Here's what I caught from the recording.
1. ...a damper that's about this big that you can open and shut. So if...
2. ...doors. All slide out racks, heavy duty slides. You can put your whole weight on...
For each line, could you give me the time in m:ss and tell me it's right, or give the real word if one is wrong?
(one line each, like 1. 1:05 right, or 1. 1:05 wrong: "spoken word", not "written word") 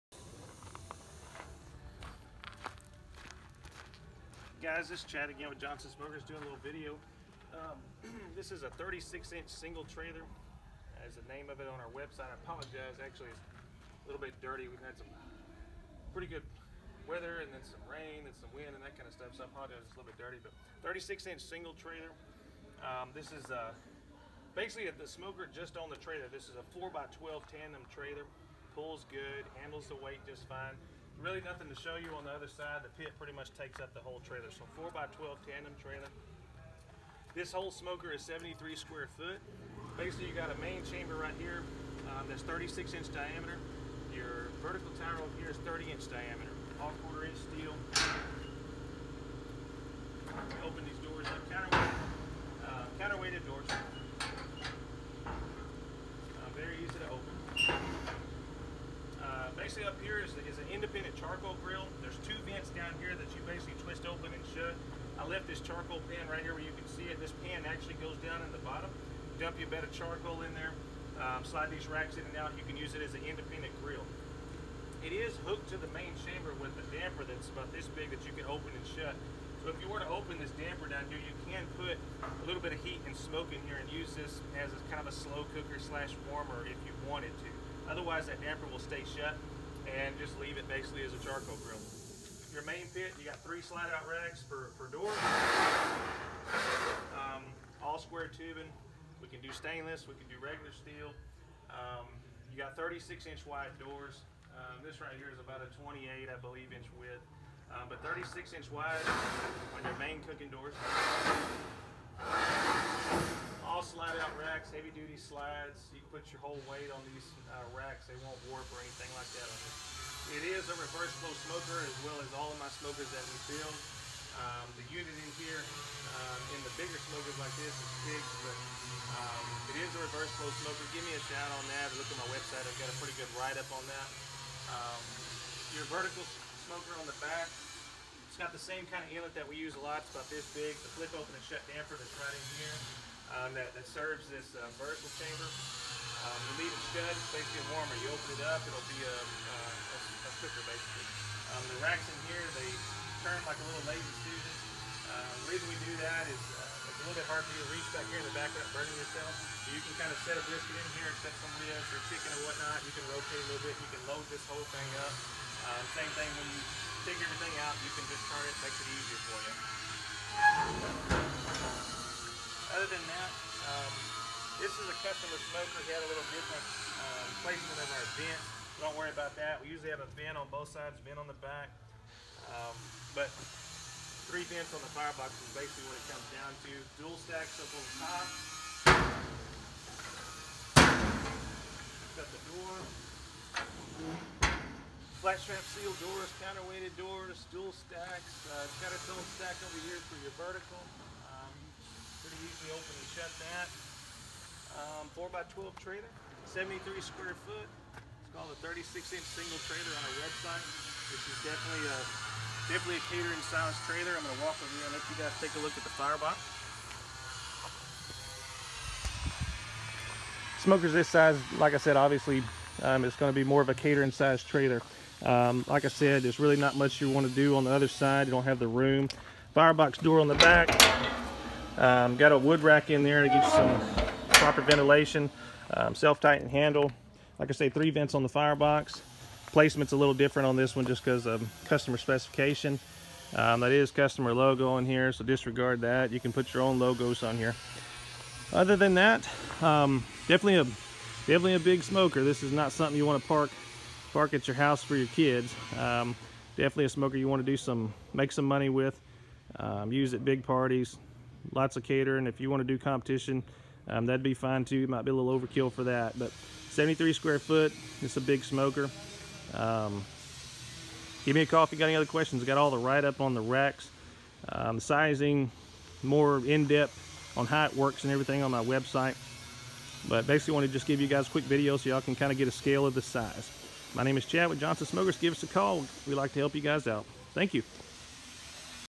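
1. 1:16 right
2. 1:50 right.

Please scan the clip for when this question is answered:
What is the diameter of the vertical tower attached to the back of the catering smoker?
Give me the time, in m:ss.
0:45.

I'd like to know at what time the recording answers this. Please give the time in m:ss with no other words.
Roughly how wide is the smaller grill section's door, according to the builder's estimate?
1:45.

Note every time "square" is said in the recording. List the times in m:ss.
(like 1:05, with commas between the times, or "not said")
0:38, 1:37, 3:27, 4:27.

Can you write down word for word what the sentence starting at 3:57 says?
Like I say, three vents on the firebox.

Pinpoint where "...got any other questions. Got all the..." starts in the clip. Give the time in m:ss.
4:31.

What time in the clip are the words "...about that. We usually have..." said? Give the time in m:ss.
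2:59.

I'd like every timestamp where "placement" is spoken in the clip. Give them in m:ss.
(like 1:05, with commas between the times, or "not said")
2:57, 3:59.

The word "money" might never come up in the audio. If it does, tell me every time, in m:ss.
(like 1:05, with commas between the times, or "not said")
4:18.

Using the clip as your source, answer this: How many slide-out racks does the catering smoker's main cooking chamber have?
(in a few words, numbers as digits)
3.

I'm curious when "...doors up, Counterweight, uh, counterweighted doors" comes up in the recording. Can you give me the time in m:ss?
0:51.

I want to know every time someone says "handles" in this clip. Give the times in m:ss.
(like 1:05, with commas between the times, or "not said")
0:29, 3:56.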